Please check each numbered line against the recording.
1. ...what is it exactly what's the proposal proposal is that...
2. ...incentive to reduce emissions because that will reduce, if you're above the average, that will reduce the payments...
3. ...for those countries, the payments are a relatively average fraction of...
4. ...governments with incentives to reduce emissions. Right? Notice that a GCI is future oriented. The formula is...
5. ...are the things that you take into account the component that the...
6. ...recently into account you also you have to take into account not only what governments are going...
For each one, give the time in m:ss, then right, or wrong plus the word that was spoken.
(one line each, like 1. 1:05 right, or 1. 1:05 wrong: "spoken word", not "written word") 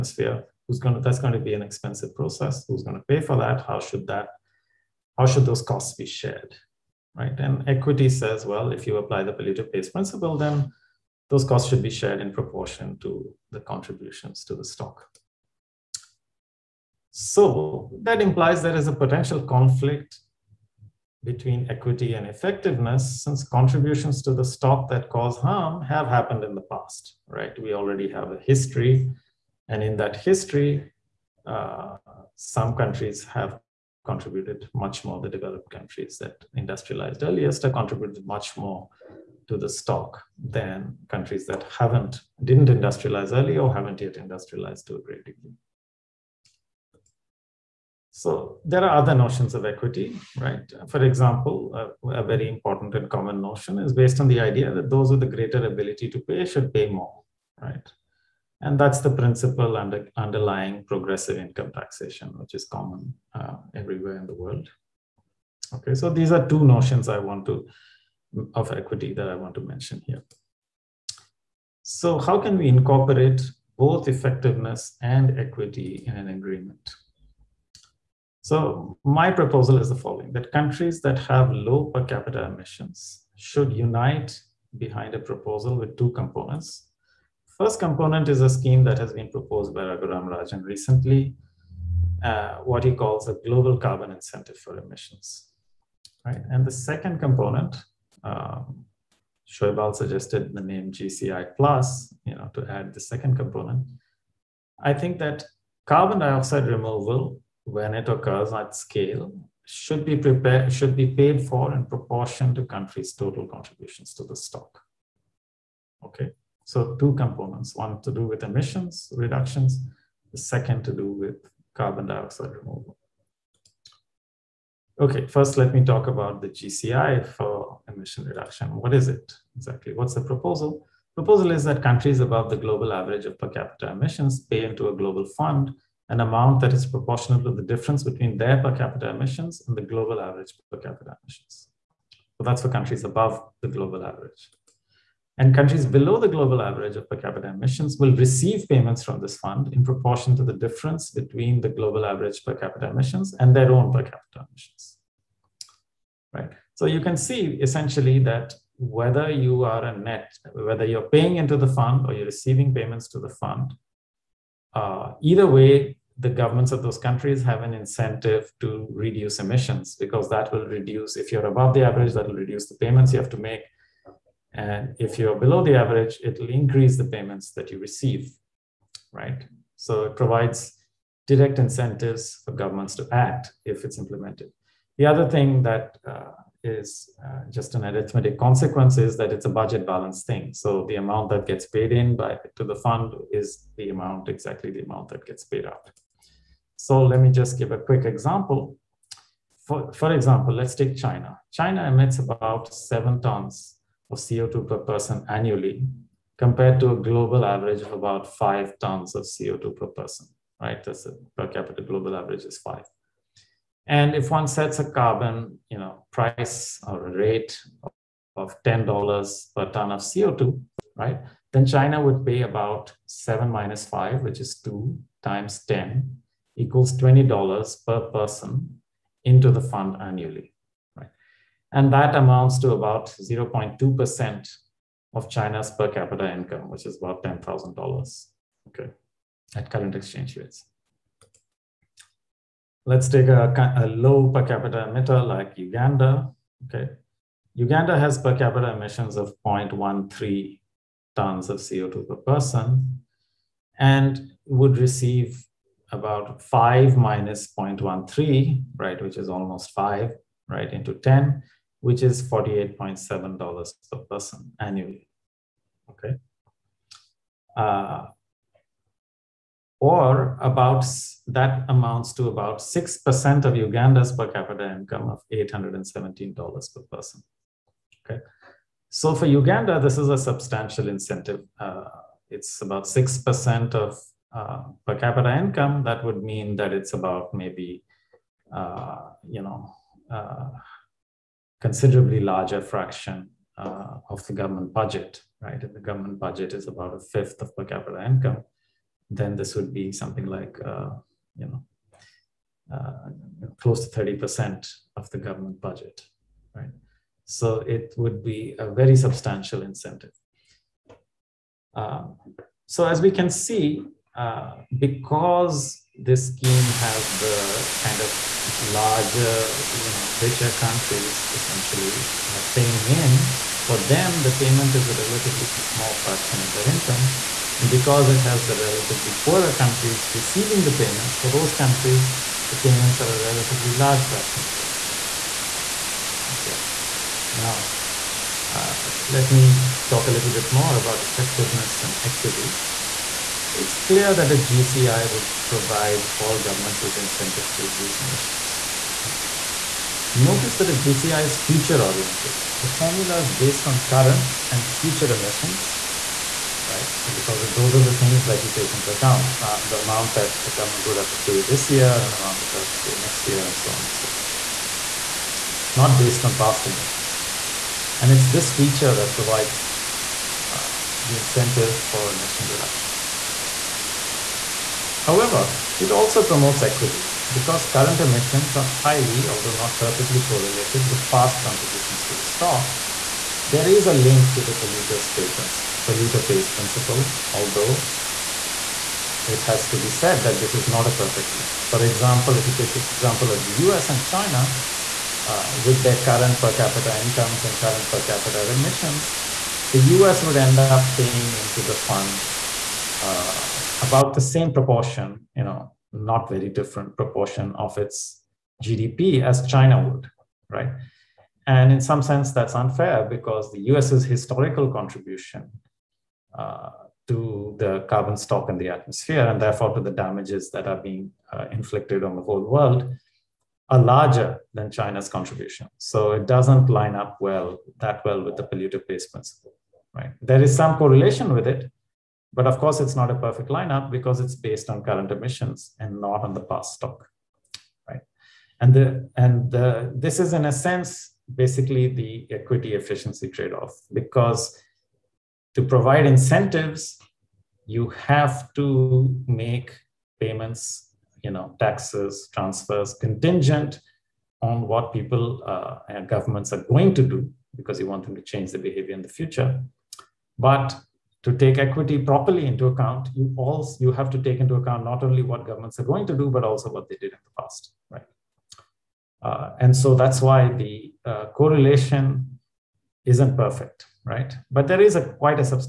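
1. 2:08 right
2. 2:47 right
3. 5:31 wrong: "large", not "average"
4. 5:46 right
5. 5:57 wrong: "amount", not "component"
6. 7:41 wrong: "properly", not "recently".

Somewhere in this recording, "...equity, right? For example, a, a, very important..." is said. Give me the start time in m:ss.
0:49.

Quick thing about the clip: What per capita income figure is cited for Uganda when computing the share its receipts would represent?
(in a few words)
$817.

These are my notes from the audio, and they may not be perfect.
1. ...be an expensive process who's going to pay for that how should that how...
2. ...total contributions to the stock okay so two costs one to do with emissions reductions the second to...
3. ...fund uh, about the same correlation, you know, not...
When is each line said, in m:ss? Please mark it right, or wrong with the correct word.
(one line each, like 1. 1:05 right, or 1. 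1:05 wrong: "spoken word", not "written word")
1. 0:01 right
2. 1:53 wrong: "components", not "costs"
3. 6:41 wrong: "proportion", not "correlation".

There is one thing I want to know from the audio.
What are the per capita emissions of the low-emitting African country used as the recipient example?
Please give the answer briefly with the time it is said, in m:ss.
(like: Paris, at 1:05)
0.13 tons, at 4:09.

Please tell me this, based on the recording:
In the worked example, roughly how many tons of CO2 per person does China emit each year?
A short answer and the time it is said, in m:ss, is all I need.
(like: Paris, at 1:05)
7 tons, at 3:22.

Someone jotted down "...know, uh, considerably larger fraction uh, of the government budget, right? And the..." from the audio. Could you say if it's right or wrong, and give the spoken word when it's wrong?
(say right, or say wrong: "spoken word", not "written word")
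right.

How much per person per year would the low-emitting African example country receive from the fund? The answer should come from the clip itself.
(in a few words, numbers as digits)
$48.7.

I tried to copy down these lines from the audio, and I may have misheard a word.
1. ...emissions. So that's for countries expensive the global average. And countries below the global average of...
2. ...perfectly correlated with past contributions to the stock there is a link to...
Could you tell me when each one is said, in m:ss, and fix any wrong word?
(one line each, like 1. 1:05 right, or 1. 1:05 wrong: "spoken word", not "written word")
1. 2:21 wrong: "above", not "expensive"
2. 6:19 right.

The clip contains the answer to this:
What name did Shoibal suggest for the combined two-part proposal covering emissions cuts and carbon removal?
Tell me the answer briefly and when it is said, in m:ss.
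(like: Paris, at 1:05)
GCI plus, at 1:40.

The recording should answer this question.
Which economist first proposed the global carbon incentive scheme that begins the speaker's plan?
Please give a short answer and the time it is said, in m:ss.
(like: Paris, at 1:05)
Raghuram Rajan, at 1:29.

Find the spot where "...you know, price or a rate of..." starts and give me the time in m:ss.
3:35.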